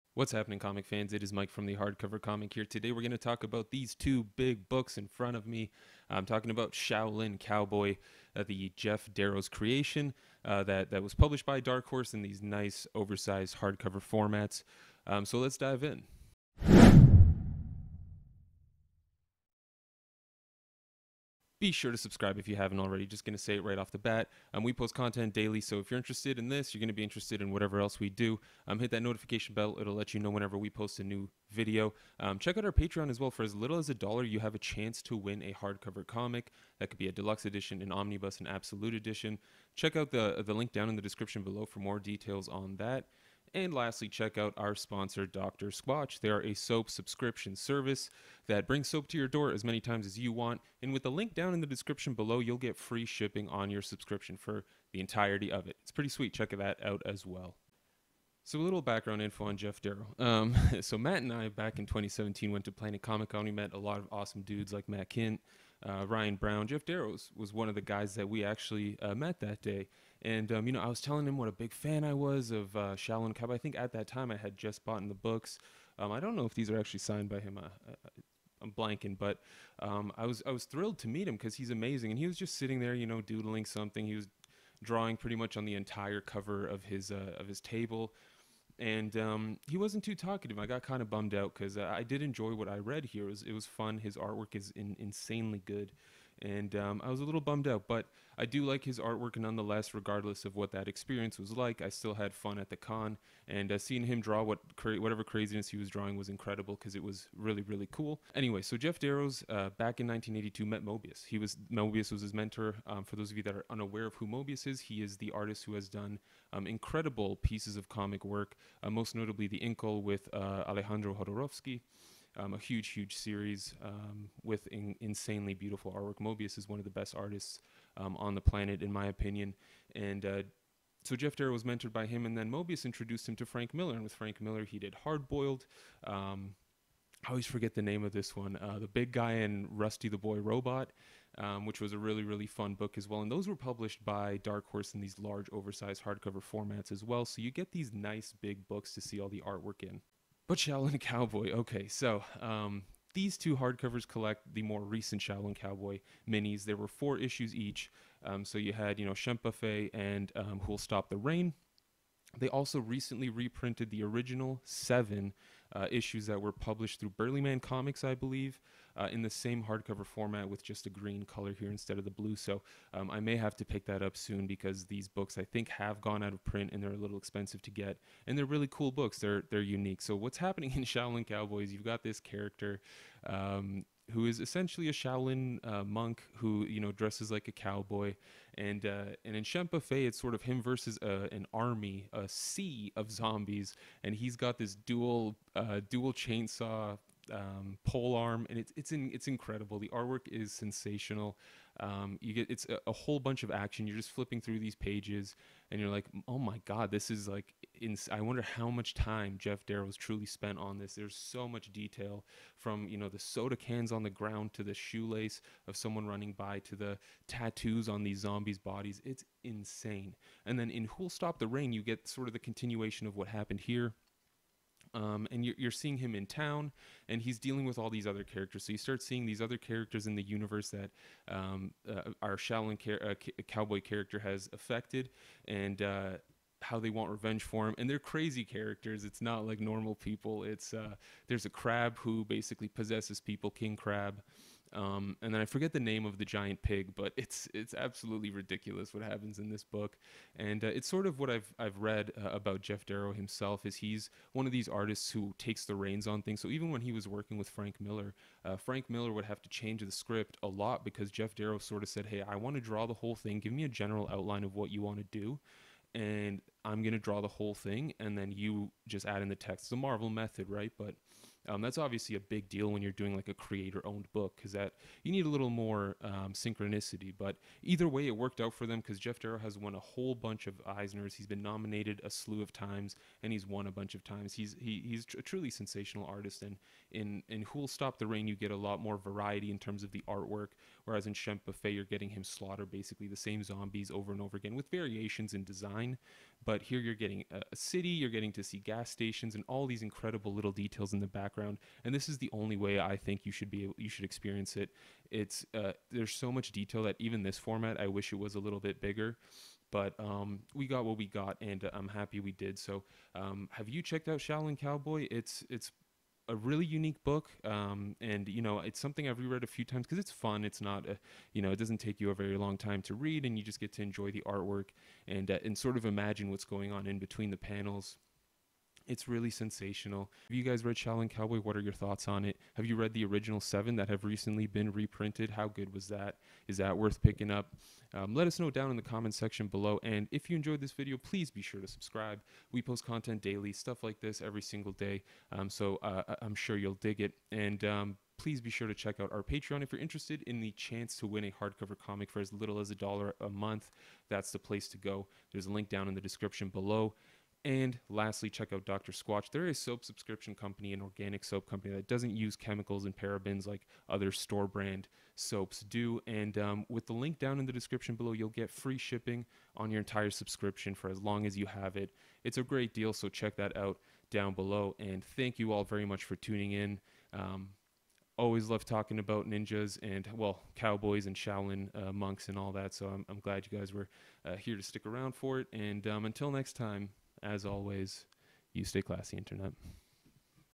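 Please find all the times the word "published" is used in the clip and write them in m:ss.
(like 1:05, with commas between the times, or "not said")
0:11, 2:23, 2:46.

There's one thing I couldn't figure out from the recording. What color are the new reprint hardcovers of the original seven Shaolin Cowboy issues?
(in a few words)
Green.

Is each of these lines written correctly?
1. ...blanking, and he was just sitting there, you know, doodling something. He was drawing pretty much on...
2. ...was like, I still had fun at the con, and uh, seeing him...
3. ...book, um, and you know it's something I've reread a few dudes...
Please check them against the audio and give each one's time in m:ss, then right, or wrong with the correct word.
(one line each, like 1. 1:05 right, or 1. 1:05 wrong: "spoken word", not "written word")
1. 1:21 wrong: "amazing", not "blanking"
2. 1:41 right
3. 5:17 wrong: "times", not "dudes".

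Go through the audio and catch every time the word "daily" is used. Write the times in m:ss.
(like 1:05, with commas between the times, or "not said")
0:25, 5:43.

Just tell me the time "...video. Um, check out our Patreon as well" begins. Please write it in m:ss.
0:31.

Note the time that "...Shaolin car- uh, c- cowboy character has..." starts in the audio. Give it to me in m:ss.
3:52.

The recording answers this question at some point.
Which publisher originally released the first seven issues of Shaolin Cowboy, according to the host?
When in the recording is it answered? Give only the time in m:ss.
2:47.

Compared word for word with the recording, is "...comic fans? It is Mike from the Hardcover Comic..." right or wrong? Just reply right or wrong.
right.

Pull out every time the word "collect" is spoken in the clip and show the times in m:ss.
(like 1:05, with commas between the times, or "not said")
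2:34.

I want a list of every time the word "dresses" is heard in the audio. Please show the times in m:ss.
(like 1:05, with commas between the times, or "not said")
3:06.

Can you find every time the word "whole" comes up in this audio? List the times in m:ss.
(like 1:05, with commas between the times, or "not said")
3:22, 4:22, 4:27, 4:39.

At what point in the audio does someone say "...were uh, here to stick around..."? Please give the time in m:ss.
6:23.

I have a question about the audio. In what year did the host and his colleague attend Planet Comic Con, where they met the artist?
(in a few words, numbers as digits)
2017.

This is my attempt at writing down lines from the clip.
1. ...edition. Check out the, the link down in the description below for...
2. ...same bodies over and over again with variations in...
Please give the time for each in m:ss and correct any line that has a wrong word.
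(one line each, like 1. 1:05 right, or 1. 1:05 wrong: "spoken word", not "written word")
1. 0:38 right
2. 4:53 wrong: "zombies", not "bodies".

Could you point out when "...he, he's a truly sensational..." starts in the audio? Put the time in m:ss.
4:44.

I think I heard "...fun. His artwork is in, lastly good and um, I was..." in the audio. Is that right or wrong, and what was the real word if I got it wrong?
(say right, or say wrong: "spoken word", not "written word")
wrong: "insanely", not "lastly".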